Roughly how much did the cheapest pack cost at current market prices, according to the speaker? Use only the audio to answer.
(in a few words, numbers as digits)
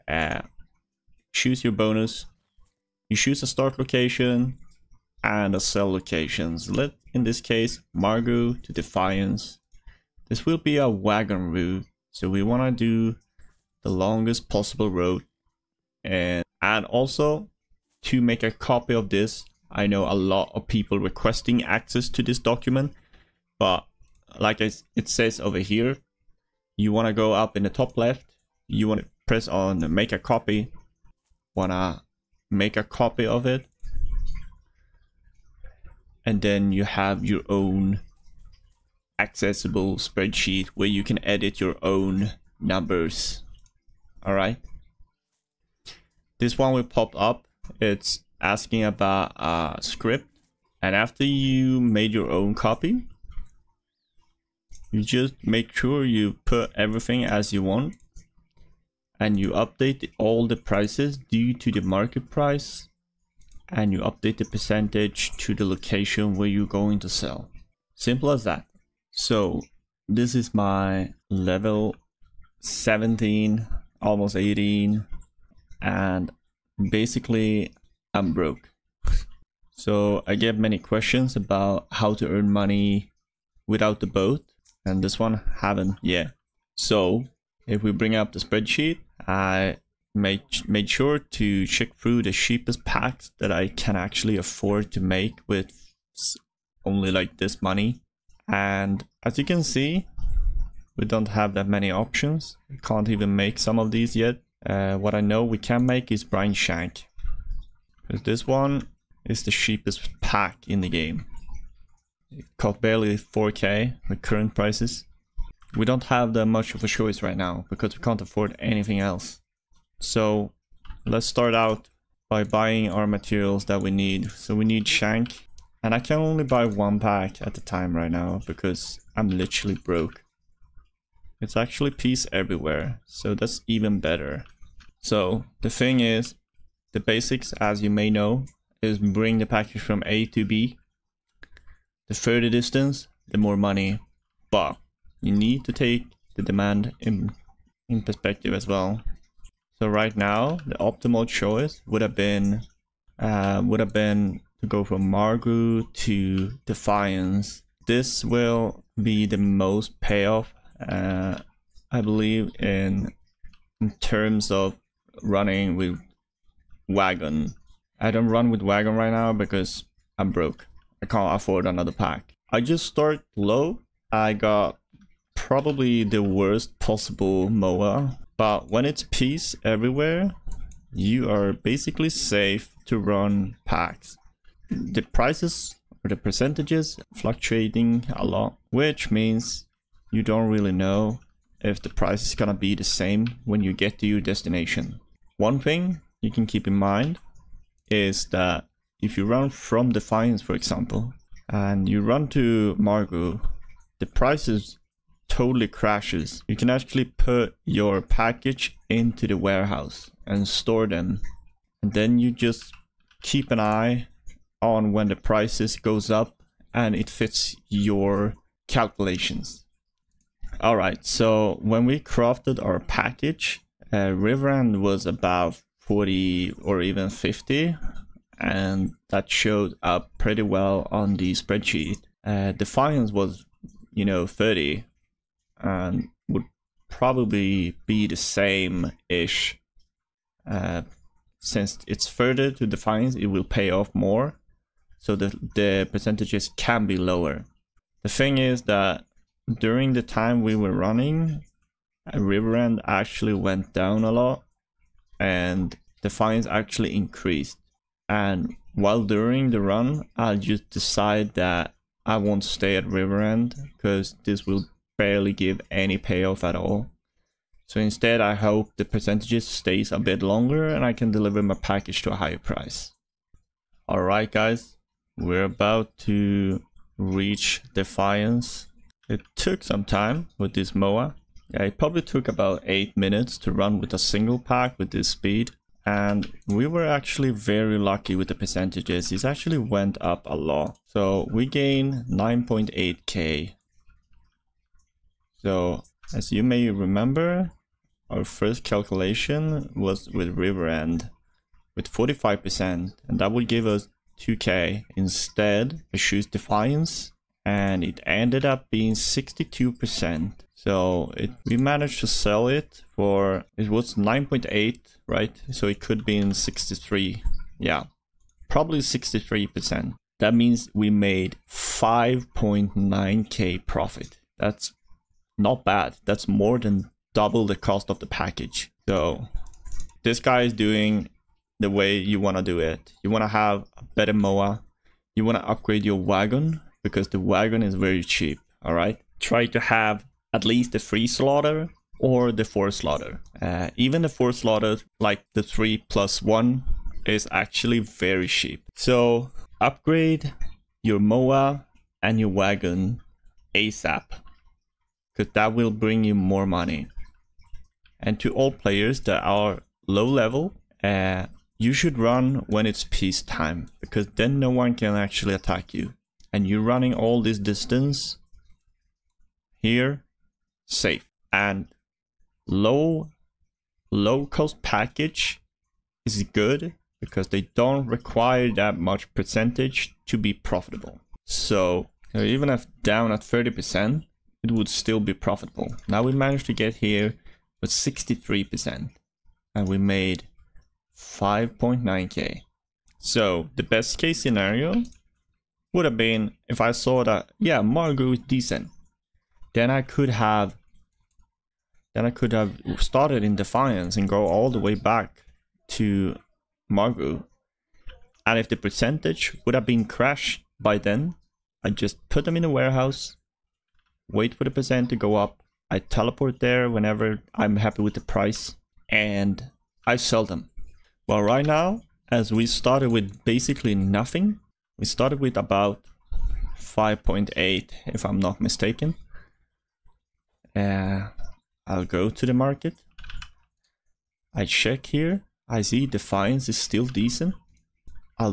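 4k.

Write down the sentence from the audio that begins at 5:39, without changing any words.
Try to have at least the 3 slotter or the 4 slotter.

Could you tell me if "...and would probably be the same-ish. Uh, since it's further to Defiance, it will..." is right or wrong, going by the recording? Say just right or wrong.
right.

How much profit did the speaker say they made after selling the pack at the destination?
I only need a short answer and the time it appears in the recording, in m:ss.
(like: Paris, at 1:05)
5.9k, at 5:21.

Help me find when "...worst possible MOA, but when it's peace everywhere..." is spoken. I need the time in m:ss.
2:56.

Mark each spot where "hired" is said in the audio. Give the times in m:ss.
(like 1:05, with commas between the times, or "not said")
not said.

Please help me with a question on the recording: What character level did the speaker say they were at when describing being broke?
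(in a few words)
17.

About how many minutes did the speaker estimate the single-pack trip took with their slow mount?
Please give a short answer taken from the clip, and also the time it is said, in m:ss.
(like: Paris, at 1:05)
8, at 4:42.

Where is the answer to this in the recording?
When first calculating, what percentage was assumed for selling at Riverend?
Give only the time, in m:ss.
5:01.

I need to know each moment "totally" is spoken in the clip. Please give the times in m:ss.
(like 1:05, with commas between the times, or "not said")
3:25.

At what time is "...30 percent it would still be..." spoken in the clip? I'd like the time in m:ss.
6:23.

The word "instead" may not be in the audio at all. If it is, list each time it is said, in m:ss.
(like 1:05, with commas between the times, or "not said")
4:27, 5:04.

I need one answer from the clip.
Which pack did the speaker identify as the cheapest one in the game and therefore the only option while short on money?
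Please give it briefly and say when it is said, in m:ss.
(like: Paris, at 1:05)
Brine Shank, at 1:46.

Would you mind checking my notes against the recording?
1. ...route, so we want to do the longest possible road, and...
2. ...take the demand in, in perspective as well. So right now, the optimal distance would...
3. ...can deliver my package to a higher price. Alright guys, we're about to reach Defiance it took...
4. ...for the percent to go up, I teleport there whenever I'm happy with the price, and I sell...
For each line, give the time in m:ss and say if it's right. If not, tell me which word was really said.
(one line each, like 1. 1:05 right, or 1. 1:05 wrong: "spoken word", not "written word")
1. 0:11 right
2. 2:25 wrong: "choice", not "distance"
3. 4:30 right
4. 6:54 right.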